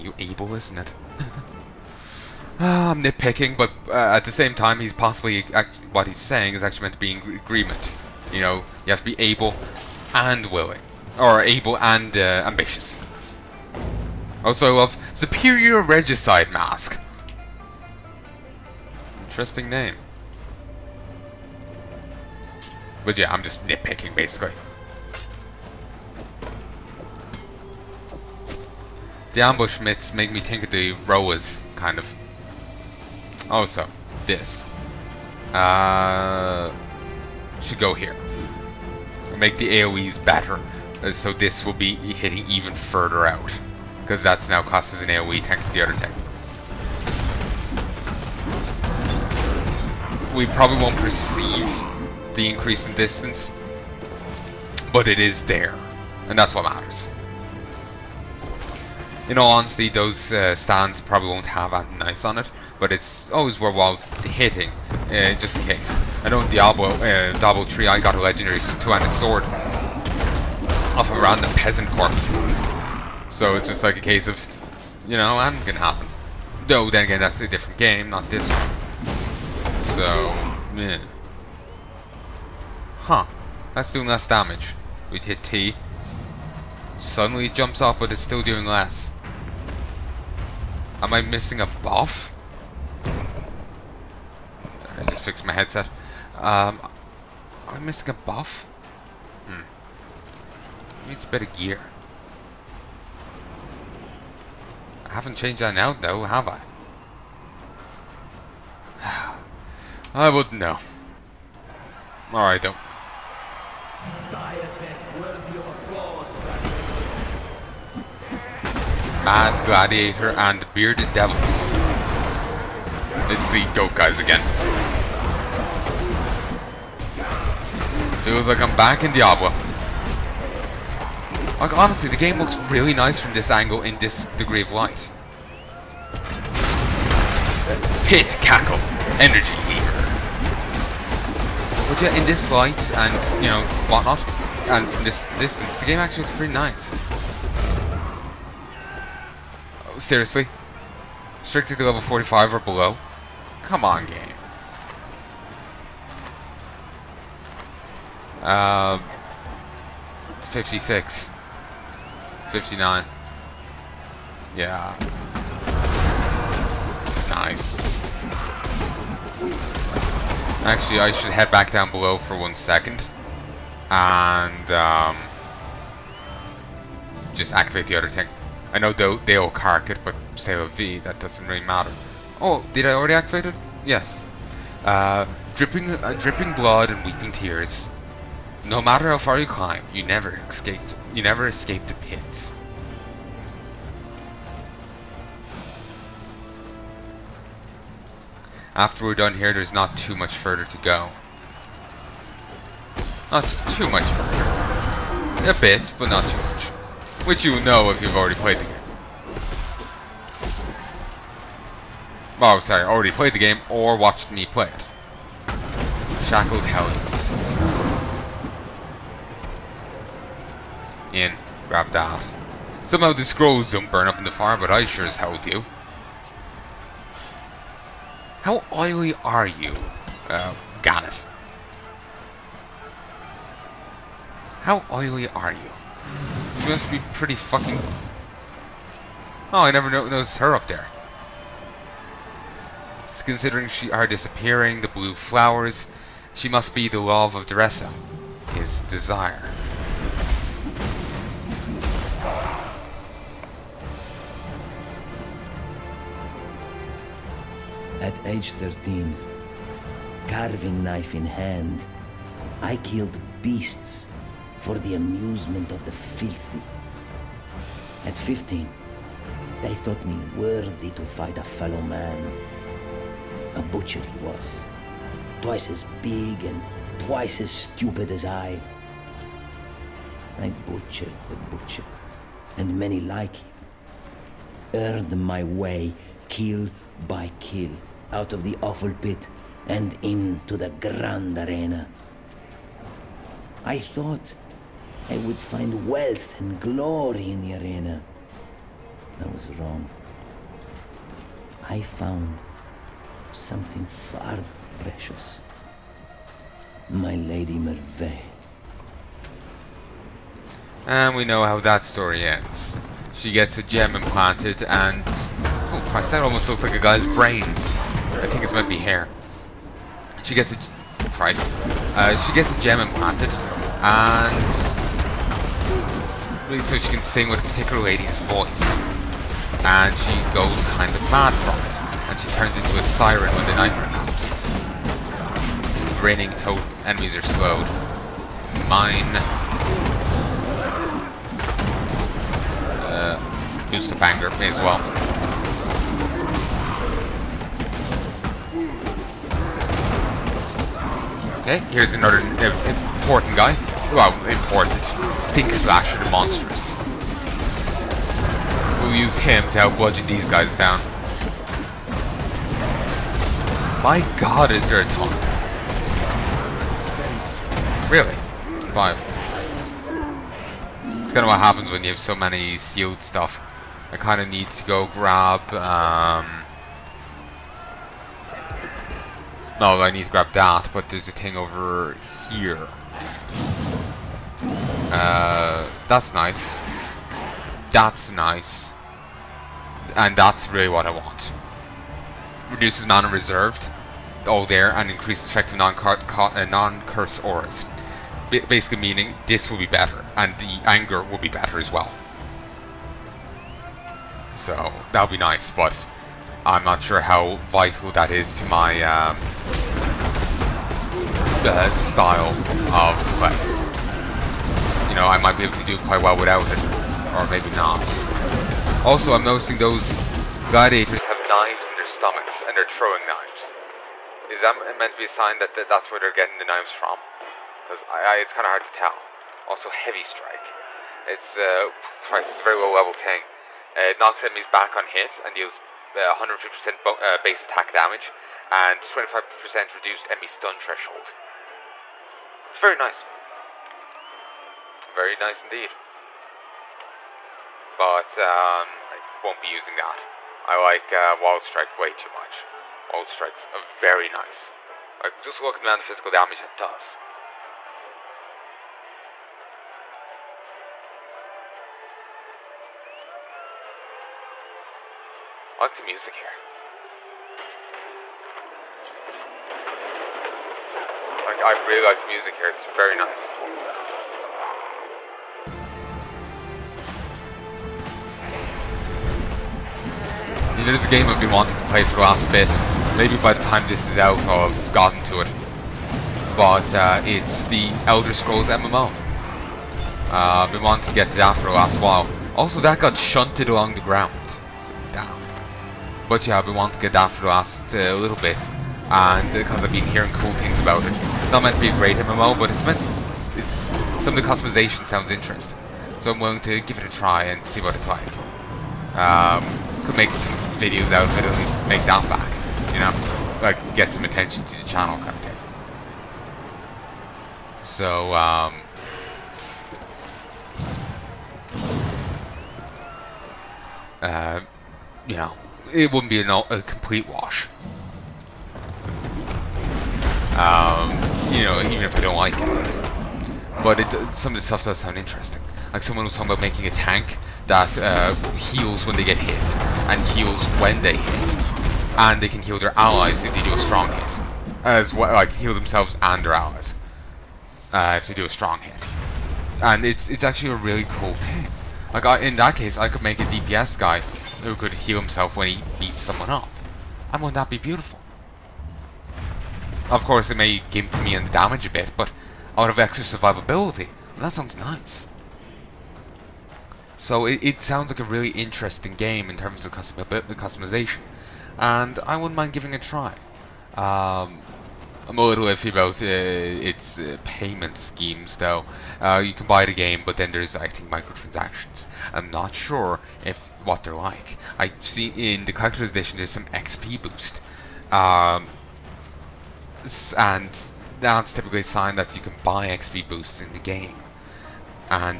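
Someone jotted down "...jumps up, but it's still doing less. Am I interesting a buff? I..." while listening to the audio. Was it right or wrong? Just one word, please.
wrong.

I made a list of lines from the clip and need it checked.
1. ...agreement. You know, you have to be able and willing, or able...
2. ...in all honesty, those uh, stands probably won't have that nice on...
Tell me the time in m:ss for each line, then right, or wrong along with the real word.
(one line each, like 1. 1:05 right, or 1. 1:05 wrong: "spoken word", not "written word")
1. 0:07 right
2. 0:59 right.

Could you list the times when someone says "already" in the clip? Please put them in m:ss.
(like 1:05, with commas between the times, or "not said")
3:02, 3:28, 3:32.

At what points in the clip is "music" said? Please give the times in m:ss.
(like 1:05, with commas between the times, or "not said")
7:45, 7:52.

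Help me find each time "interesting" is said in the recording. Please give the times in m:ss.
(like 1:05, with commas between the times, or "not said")
0:19, 8:25, 8:54, 9:28.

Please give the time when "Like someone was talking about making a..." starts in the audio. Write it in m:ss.
8:55.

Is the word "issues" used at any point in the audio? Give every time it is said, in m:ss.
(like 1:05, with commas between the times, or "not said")
not said.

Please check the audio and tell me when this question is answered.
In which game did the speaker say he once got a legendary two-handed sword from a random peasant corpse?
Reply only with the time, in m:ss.
1:07.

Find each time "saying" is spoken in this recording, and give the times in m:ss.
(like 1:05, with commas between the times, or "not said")
0:06.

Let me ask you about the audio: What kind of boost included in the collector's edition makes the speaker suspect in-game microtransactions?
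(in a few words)
XP boost.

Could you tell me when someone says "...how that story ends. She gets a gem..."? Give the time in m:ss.
5:11.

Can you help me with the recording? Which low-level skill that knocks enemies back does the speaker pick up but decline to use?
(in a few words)
Heavy Strike.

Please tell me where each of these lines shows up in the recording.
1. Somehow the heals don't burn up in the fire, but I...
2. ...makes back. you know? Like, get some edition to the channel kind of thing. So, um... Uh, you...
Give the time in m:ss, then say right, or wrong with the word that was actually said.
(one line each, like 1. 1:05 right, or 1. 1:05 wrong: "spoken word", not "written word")
1. 3:42 wrong: "scrolls", not "heals"
2. 8:31 wrong: "attention", not "edition".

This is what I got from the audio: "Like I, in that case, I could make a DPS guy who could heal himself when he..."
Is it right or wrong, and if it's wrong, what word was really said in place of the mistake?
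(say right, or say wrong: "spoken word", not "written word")
right.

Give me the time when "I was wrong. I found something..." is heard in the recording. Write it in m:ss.
4:59.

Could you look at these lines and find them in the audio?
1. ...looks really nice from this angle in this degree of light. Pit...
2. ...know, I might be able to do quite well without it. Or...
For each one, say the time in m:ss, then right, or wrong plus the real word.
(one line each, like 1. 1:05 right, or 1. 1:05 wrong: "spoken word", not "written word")
1. 2:12 right
2. 6:54 right.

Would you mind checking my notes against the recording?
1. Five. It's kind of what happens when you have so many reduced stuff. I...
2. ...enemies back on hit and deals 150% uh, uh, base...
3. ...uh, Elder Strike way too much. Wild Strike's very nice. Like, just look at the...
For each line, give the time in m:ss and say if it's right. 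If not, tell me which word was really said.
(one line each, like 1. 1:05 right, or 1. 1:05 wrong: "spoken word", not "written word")
1. 6:08 wrong: "sealed", not "reduced"
2. 7:14 right
3. 7:30 wrong: "Wild", not "Elder".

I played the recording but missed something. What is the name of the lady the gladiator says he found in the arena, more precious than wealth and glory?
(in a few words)
Merveil.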